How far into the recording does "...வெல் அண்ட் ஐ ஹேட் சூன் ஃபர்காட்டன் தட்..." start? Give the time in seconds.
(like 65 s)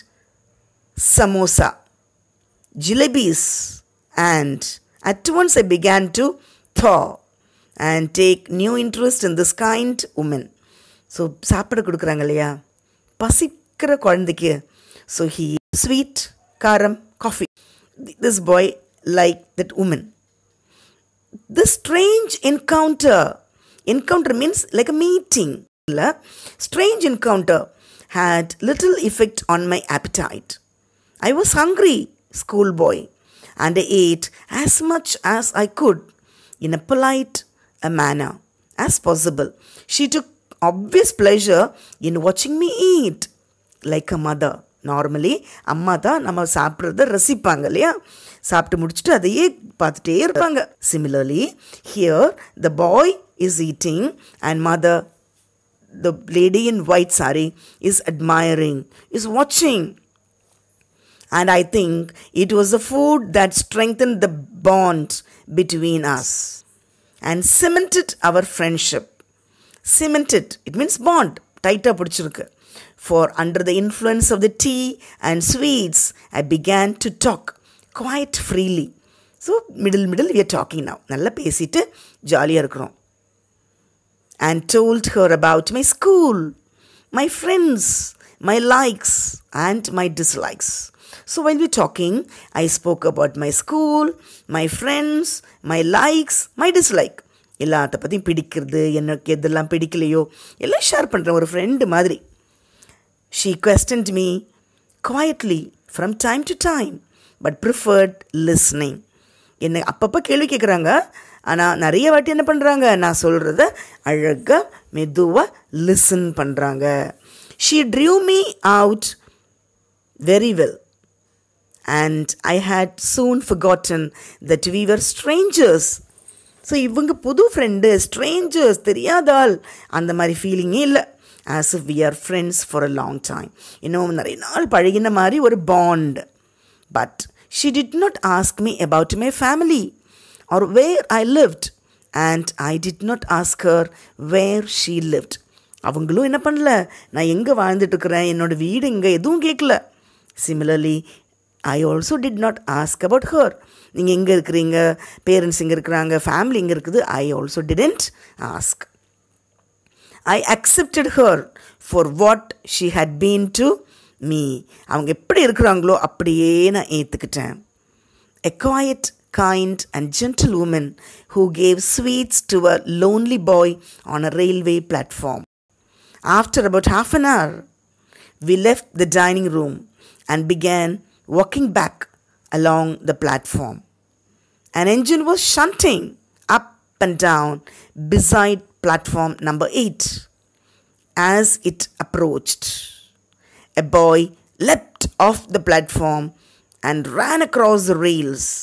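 120 s.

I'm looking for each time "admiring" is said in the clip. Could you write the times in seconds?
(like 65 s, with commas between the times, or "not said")
58 s.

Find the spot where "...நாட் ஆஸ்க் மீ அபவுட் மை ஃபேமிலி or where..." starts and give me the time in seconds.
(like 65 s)
138 s.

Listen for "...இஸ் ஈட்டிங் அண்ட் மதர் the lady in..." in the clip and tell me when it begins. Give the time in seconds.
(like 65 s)
53 s.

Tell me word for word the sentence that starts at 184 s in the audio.
An engine was shunting up and down beside platform number 8.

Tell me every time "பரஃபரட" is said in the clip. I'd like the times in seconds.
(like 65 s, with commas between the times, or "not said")
107 s.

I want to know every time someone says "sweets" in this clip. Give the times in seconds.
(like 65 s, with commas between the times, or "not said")
15 s, 75 s, 171 s.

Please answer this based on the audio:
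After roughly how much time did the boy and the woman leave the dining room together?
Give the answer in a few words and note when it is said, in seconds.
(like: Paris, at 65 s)
Half an hour, at 176 s.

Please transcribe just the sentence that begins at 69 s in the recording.
Cemented, it means bond, tighter pidichirukku.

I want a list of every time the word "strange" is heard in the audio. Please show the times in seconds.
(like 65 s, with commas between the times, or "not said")
21 s, 26 s.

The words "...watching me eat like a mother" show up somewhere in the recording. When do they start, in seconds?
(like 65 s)
42 s.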